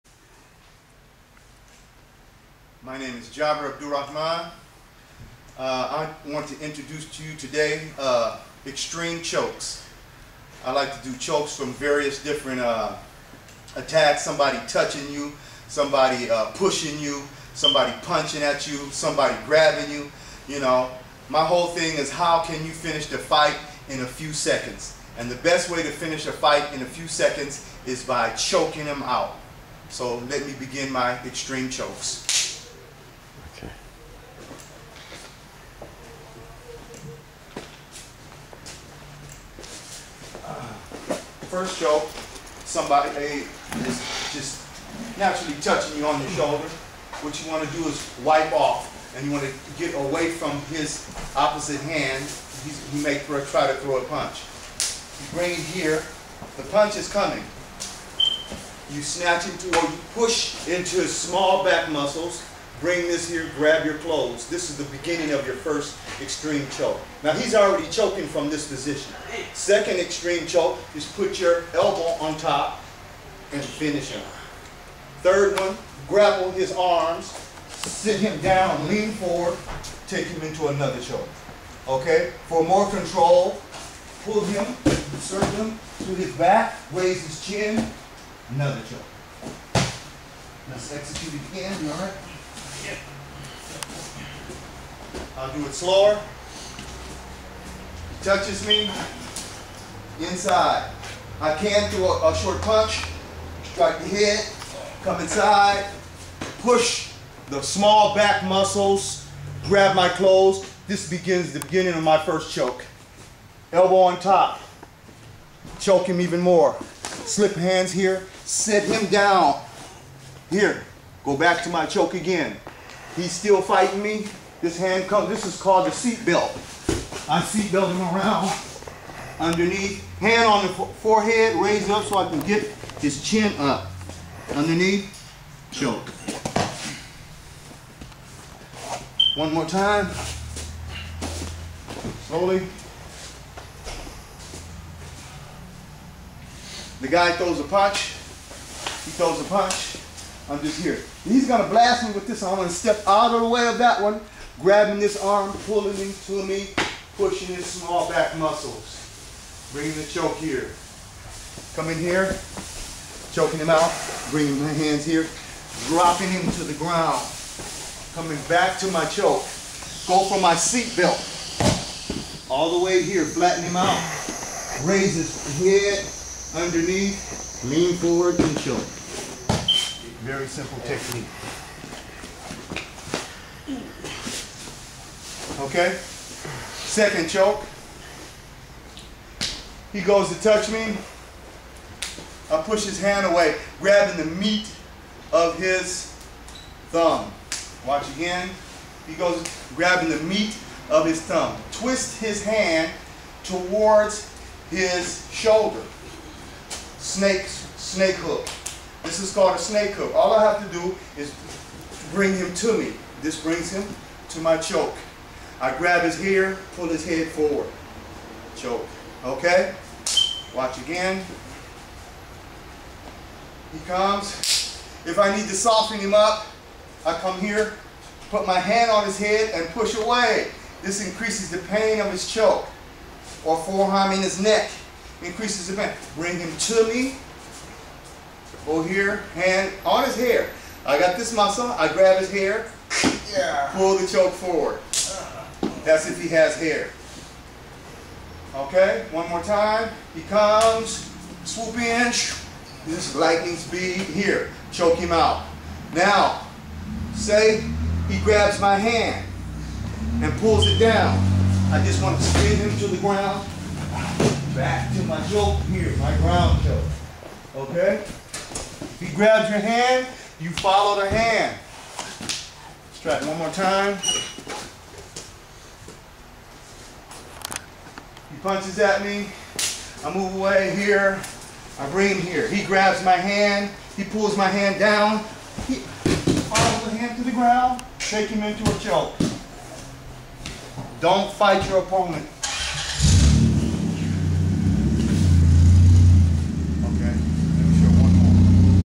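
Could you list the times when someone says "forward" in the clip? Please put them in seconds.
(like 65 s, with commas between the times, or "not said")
79 s, 177 s, 217 s, 244 s.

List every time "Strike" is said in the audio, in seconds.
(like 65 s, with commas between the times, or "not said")
103 s.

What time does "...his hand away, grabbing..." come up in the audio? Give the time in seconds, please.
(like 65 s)
192 s.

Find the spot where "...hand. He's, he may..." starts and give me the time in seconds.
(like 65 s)
51 s.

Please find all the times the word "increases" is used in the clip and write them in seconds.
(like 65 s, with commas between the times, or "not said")
231 s, 235 s.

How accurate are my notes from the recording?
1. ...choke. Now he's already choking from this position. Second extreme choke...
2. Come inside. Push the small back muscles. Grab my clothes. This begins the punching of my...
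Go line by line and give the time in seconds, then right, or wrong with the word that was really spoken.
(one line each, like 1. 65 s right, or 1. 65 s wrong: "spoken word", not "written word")
1. 66 s right
2. 105 s wrong: "beginning", not "punching".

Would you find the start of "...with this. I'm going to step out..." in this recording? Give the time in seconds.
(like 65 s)
152 s.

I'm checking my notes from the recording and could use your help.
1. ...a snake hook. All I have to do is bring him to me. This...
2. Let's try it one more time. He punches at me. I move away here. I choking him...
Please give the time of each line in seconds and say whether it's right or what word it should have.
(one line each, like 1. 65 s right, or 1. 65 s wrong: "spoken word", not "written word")
1. 209 s right
2. 271 s wrong: "bring", not "choking".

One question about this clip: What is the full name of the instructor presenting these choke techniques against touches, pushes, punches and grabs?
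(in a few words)
Jaber Abdurrahman.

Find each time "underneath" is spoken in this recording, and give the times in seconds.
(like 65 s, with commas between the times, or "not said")
129 s, 134 s, 176 s.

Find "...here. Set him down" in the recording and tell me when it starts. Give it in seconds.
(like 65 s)
117 s.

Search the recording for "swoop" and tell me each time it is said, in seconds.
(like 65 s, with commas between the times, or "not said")
251 s.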